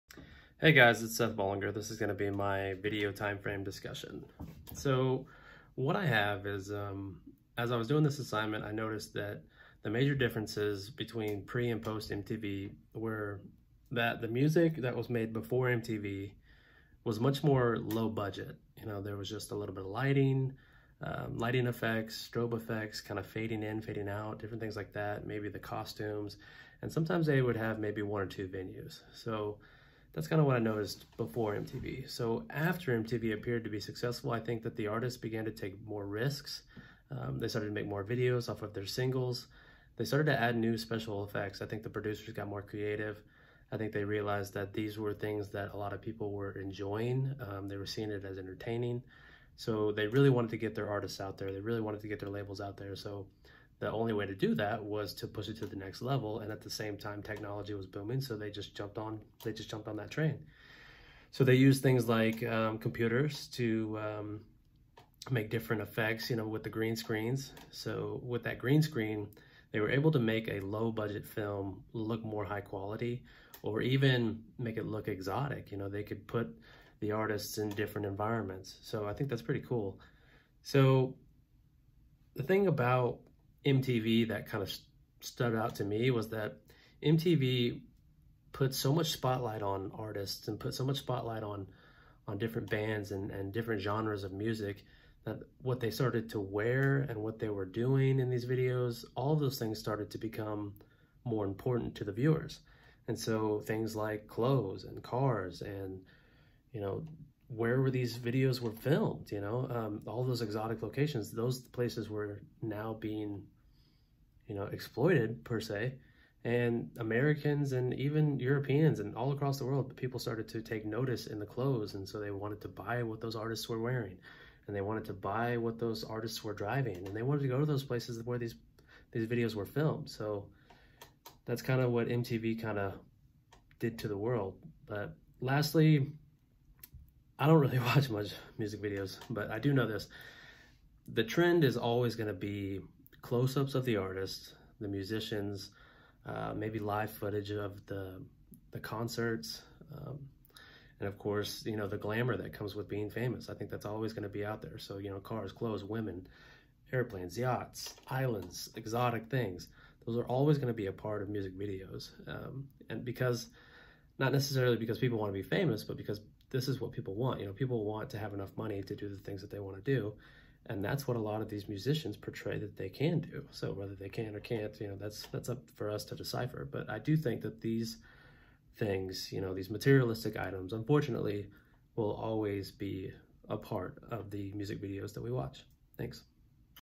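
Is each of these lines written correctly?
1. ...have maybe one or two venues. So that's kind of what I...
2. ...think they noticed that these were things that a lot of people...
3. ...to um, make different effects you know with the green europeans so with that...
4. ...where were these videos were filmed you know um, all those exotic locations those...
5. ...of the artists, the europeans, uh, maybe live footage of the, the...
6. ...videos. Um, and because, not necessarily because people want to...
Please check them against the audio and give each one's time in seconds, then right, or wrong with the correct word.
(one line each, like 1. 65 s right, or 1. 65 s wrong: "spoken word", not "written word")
1. 27 s right
2. 43 s wrong: "realized", not "noticed"
3. 63 s wrong: "screens", not "europeans"
4. 107 s right
5. 143 s wrong: "musicians", not "europeans"
6. 161 s right.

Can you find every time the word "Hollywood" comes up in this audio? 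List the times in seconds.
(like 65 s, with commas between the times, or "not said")
not said.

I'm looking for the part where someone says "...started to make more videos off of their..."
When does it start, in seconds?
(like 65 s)
37 s.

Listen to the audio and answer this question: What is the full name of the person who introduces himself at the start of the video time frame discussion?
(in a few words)
Seth Bollinger.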